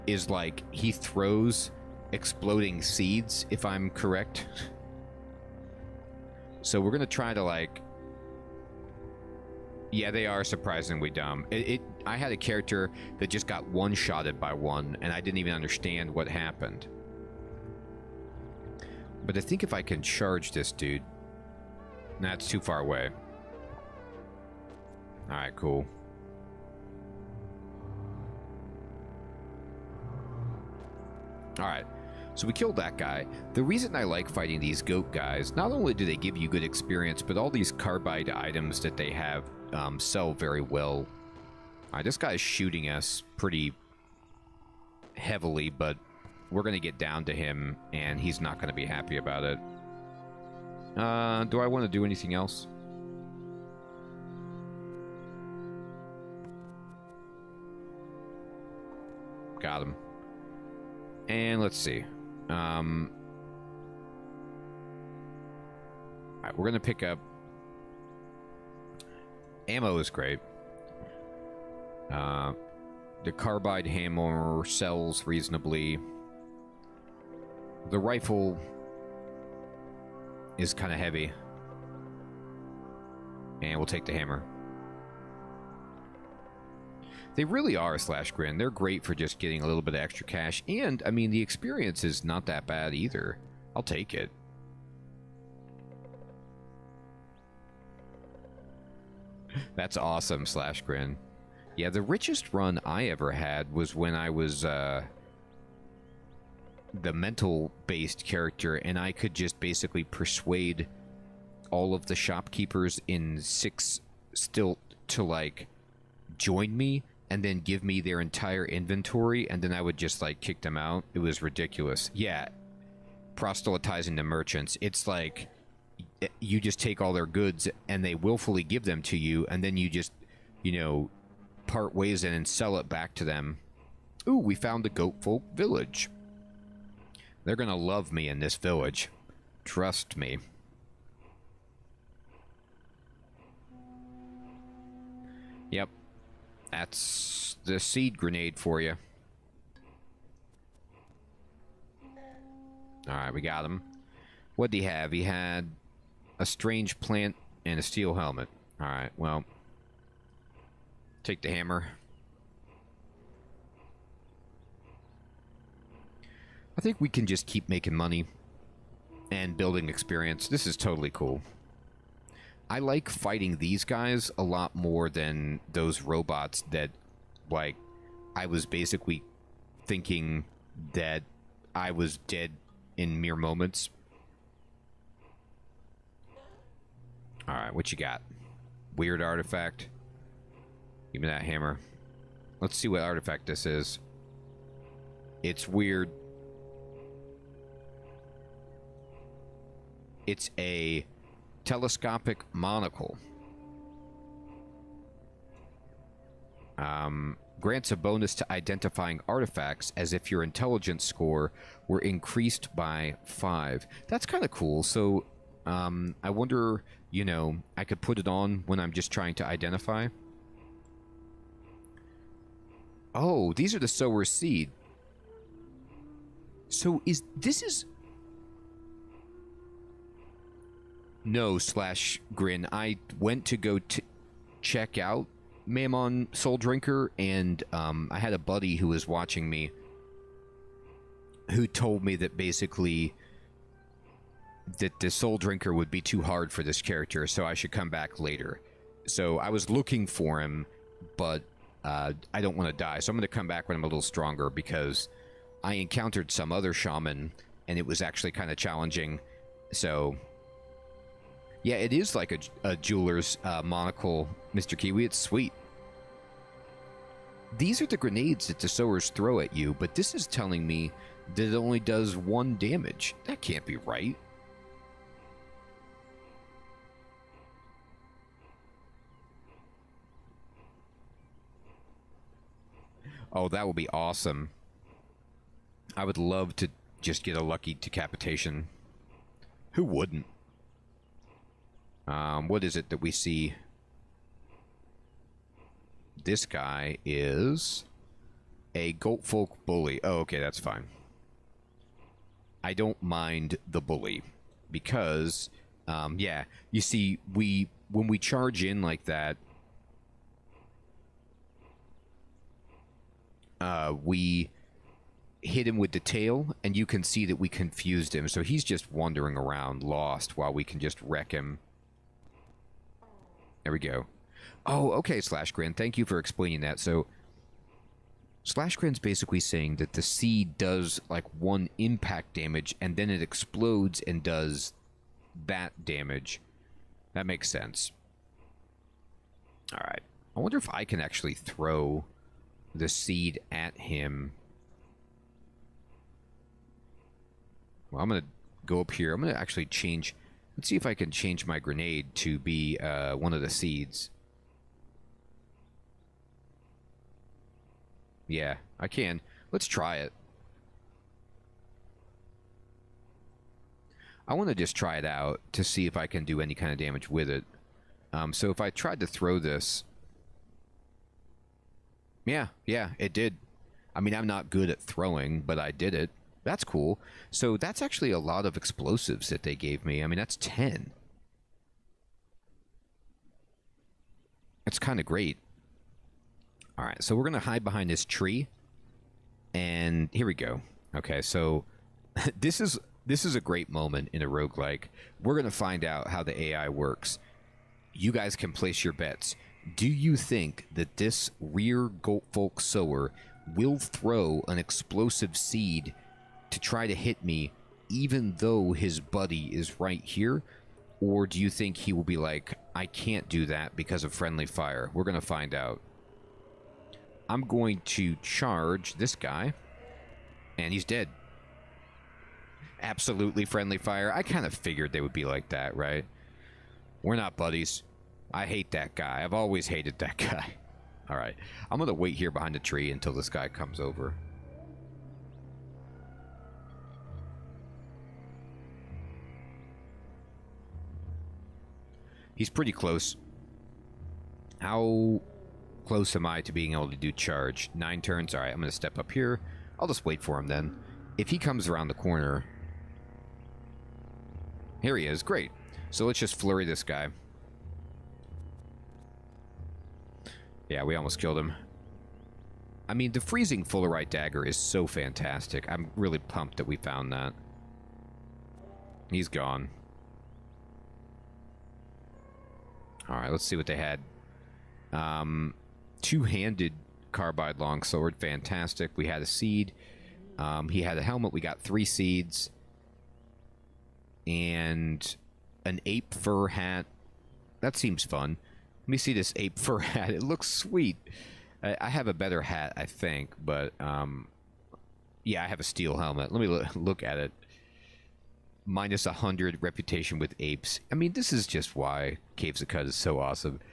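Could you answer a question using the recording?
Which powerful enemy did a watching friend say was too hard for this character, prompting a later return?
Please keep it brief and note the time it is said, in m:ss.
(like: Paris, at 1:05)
Mamon Souldrinker, at 3:55.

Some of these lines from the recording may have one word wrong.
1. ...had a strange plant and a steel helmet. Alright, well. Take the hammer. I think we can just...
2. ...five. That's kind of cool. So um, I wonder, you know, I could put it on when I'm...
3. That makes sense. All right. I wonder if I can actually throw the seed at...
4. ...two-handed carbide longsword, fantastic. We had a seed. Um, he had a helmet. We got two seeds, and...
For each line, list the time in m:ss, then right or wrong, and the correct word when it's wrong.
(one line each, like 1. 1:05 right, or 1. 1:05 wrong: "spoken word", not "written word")
1. 2:35 right
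2. 3:33 right
3. 5:37 right
4. 7:56 wrong: "three", not "two".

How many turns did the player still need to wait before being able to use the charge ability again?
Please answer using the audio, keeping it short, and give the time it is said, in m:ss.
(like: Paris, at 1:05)
9, at 7:27.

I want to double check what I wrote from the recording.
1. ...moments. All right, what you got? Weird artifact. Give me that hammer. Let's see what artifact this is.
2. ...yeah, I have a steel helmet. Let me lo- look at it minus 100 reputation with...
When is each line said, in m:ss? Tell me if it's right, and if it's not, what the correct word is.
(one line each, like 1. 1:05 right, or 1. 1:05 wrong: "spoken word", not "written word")
1. 3:03 right
2. 8:15 right.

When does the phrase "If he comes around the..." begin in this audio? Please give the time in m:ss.
7:31.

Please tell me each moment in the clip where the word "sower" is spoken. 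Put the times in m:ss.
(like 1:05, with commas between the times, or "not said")
3:43, 4:28, 6:42.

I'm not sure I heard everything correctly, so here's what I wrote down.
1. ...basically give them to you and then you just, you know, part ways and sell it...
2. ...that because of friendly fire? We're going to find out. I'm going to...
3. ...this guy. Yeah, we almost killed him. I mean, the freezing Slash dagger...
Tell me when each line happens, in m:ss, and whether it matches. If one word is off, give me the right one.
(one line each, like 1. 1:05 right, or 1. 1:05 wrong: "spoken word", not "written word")
1. 2:08 wrong: "willfully", not "basically"
2. 6:53 right
3. 7:36 wrong: "Fullerite", not "Slash".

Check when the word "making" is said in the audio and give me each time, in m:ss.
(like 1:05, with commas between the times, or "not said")
2:47.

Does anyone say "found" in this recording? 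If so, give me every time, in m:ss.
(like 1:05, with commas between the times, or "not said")
2:14, 7:46.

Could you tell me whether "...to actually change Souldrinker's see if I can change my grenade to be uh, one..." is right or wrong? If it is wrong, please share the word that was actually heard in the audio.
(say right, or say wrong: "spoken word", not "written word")
wrong: "Let", not "Souldrinker".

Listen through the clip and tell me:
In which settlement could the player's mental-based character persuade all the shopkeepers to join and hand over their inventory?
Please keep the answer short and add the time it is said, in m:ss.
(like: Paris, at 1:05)
Six Stilt, at 1:53.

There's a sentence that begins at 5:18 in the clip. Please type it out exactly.
So he's just wandering around, lost, while we can just wreck him there we go.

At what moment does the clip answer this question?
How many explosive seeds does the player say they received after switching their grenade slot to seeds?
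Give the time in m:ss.
6:20.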